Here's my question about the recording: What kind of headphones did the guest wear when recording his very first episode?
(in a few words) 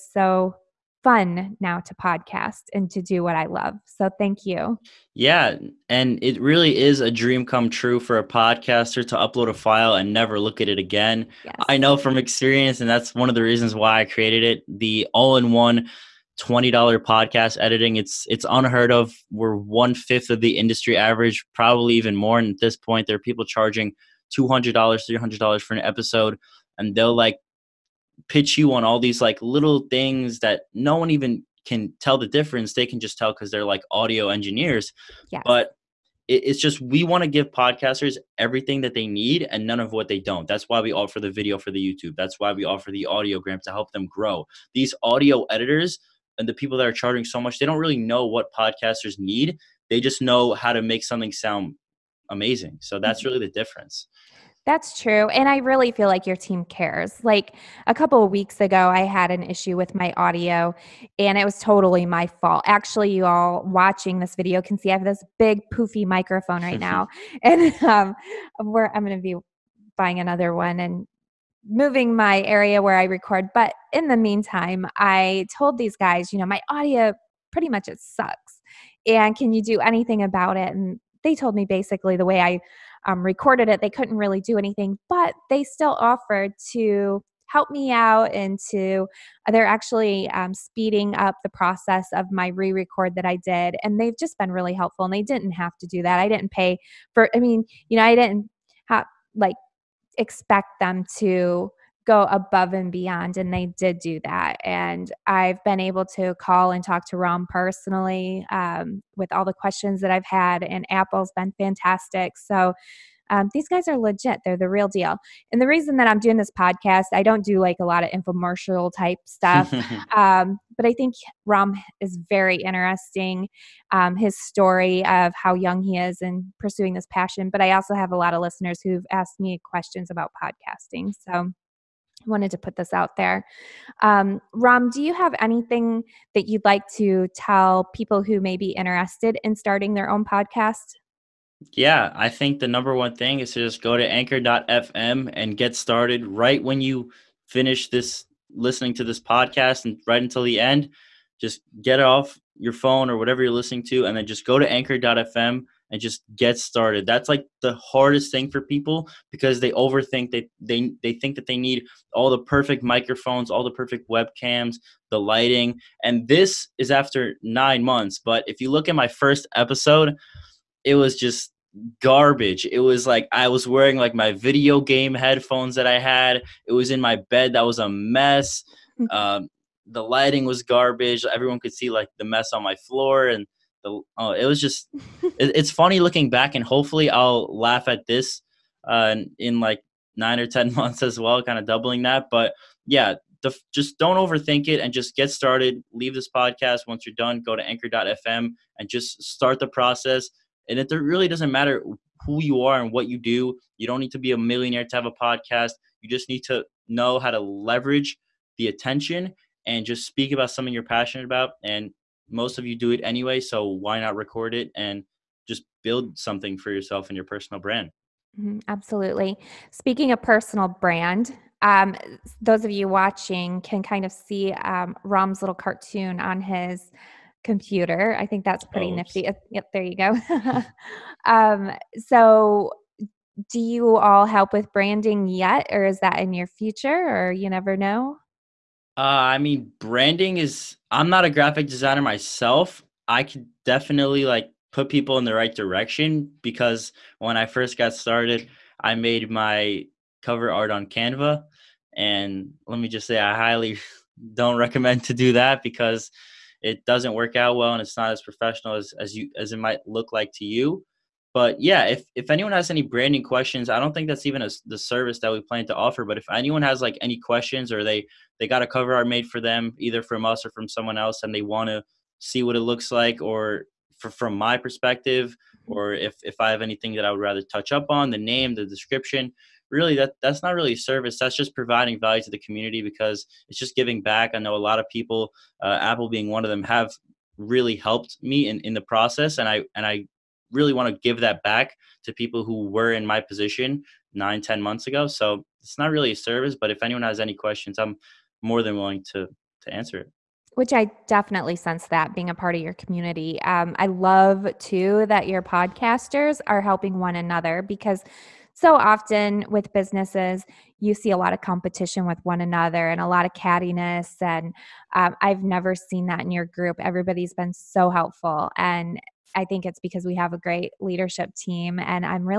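video game headphones.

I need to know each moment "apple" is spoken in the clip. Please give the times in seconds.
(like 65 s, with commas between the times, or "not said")
110 s, 285 s.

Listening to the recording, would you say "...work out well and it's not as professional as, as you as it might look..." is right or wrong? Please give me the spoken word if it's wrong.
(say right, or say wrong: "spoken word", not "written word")
right.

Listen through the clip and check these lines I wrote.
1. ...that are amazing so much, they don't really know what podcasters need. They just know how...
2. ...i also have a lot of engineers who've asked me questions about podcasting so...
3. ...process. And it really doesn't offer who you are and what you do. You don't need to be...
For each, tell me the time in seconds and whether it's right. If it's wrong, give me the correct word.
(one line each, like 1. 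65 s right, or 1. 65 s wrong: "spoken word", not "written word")
1. 46 s wrong: "charging", not "amazing"
2. 127 s wrong: "listeners", not "engineers"
3. 199 s wrong: "matter", not "offer".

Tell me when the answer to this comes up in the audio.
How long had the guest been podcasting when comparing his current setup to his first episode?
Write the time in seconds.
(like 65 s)
167 s.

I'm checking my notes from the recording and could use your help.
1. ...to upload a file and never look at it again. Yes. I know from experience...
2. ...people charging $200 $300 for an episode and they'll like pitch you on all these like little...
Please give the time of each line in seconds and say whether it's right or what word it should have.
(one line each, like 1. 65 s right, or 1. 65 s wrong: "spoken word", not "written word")
1. 9 s right
2. 23 s right.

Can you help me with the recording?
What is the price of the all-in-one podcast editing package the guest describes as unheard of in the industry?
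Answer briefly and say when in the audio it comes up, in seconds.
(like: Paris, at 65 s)
$20, at 16 s.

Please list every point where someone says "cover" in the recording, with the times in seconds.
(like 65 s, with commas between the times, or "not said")
250 s, 268 s.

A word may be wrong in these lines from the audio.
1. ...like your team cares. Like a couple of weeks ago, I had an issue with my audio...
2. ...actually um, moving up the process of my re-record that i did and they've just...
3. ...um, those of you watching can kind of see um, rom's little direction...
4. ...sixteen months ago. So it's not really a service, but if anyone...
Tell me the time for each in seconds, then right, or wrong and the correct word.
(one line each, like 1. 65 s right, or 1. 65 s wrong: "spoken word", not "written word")
1. 56 s right
2. 89 s wrong: "speeding", not "moving"
3. 221 s wrong: "cartoon", not "direction"
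4. 294 s wrong: "ten", not "sixteen".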